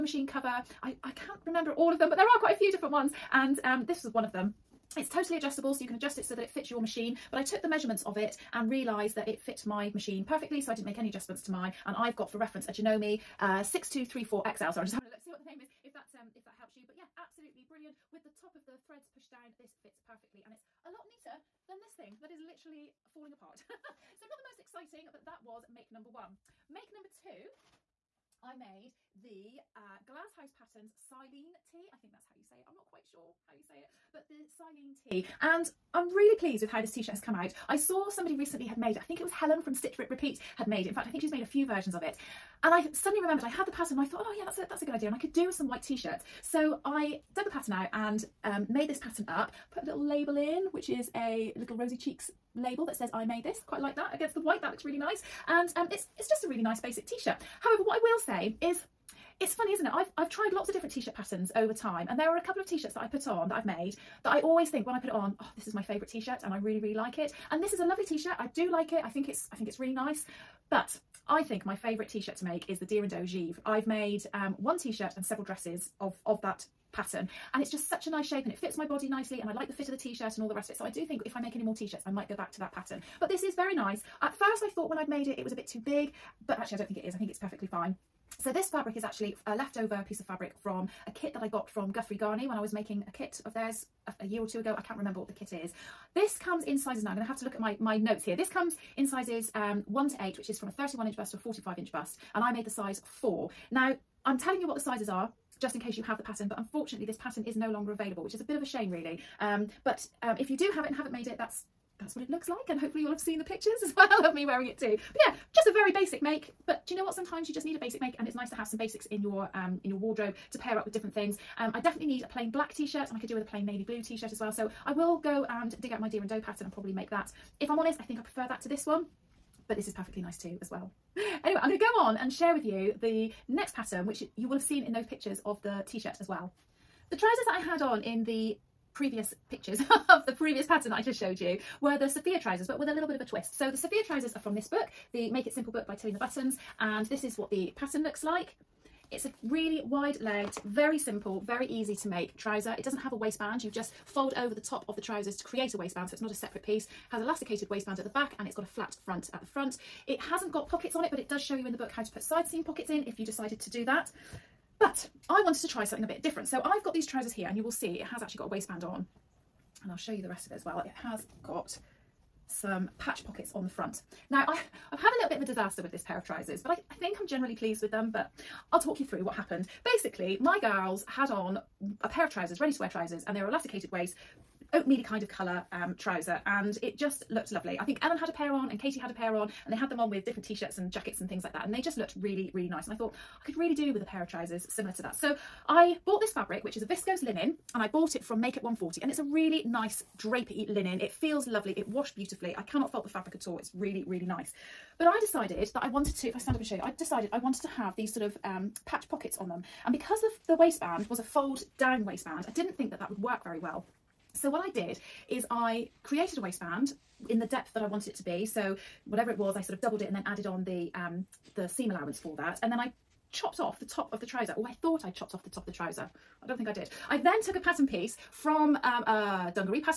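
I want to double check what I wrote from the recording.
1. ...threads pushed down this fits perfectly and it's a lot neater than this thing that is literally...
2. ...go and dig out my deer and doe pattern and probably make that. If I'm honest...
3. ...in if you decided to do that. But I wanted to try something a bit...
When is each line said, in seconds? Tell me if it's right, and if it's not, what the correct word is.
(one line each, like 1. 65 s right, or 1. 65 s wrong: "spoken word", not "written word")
1. 18 s right
2. 125 s right
3. 162 s right.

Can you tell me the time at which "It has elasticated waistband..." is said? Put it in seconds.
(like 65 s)
156 s.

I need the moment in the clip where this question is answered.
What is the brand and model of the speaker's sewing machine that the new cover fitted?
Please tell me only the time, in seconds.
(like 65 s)
12 s.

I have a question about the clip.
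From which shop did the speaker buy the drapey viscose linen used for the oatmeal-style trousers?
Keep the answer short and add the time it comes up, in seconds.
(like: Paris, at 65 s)
Make It 140, at 198 s.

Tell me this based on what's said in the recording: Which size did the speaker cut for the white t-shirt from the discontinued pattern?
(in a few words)
4.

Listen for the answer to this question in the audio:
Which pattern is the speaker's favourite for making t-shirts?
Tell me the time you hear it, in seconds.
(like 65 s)
72 s.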